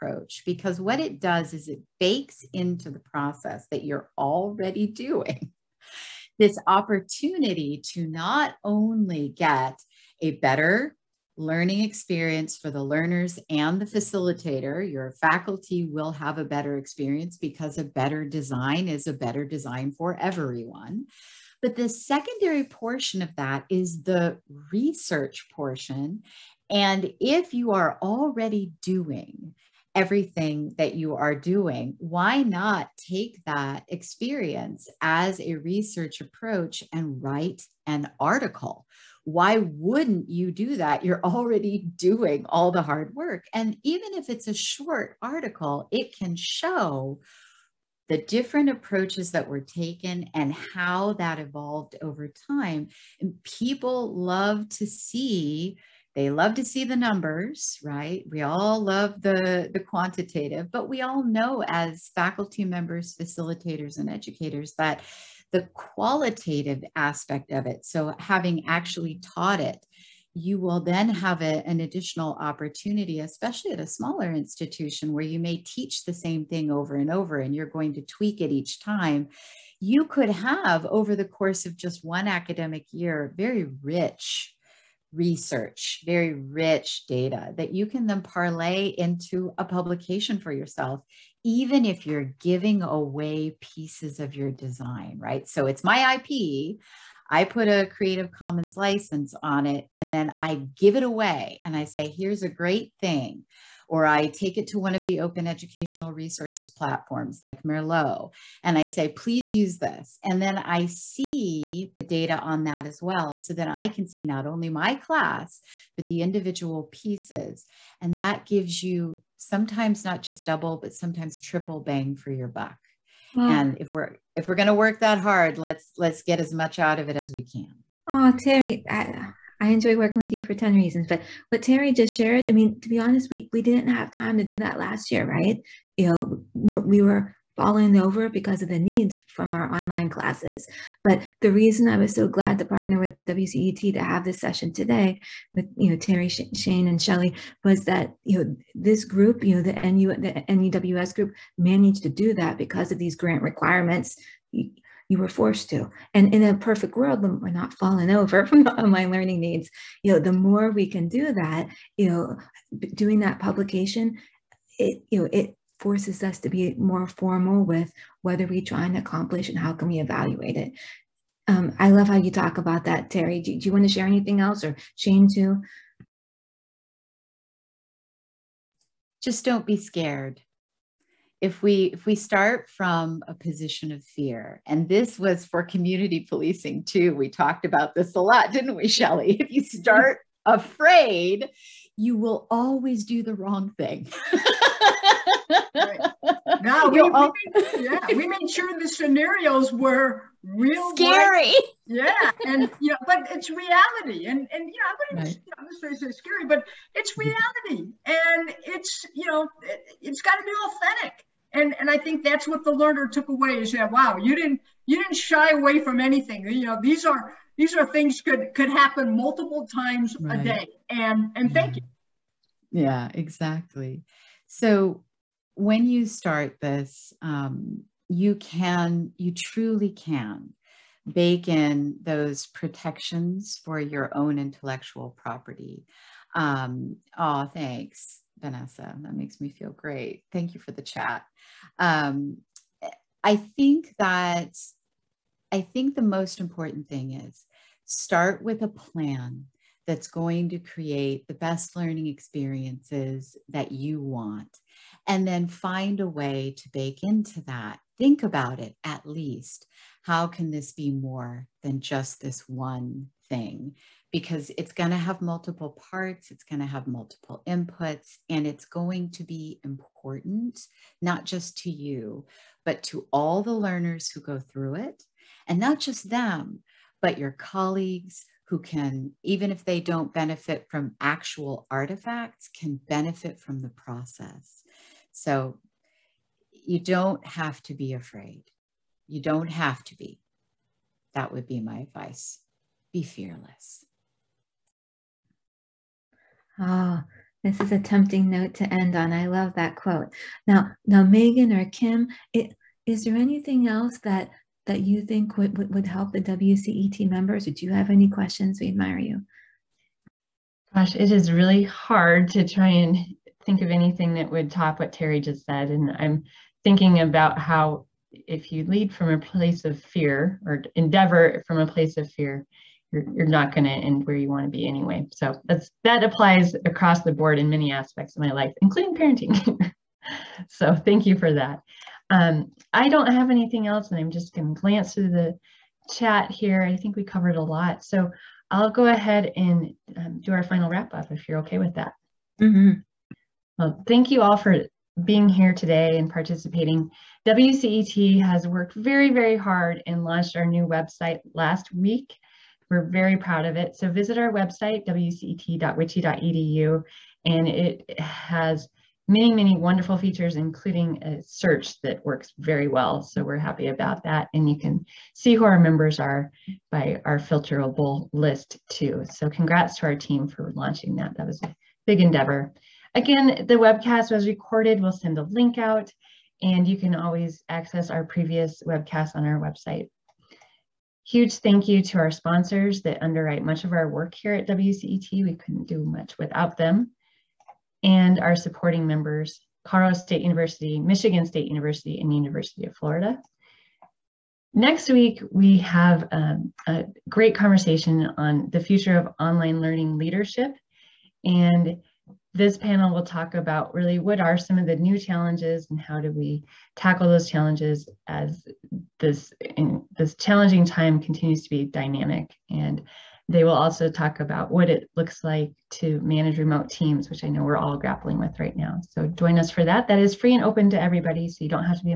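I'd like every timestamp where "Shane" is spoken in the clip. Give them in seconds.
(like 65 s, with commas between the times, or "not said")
146 s, 174 s.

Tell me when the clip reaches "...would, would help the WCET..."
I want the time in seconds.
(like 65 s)
305 s.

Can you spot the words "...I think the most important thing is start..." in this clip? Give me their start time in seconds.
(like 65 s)
245 s.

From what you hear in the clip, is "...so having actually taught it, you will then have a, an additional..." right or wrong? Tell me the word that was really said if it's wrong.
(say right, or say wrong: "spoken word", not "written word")
right.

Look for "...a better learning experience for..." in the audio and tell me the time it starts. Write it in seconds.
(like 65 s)
10 s.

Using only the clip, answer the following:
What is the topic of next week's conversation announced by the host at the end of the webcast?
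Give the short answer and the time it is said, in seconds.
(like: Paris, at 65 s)
online learning leadership, at 399 s.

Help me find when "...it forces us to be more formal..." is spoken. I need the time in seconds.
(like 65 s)
165 s.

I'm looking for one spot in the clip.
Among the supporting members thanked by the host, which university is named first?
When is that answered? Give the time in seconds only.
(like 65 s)
389 s.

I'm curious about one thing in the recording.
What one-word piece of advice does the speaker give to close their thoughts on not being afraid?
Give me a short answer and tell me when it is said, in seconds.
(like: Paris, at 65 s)
Be fearless, at 292 s.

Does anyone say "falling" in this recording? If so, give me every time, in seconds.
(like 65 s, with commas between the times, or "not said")
137 s, 157 s.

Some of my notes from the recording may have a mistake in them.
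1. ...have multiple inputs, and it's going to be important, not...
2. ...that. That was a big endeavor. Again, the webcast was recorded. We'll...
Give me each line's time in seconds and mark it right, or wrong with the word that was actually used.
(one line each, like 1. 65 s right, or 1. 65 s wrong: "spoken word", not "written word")
1. 266 s right
2. 370 s right.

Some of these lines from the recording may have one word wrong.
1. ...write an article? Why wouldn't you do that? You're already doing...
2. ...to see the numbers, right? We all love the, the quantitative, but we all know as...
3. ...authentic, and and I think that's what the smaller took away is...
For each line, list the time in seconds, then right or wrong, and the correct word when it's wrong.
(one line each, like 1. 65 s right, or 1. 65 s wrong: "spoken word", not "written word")
1. 37 s right
2. 56 s right
3. 210 s wrong: "learner", not "smaller".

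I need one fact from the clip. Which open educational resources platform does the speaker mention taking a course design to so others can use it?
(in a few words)
Merlot.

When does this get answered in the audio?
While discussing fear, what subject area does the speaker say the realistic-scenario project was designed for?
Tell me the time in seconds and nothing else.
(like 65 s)
185 s.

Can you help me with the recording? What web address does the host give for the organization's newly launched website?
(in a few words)
wcet.wiche.edu.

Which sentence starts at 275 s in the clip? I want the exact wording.
And not just them, but your colleagues who can, even if they don't benefit from actual artifacts, can benefit from the process.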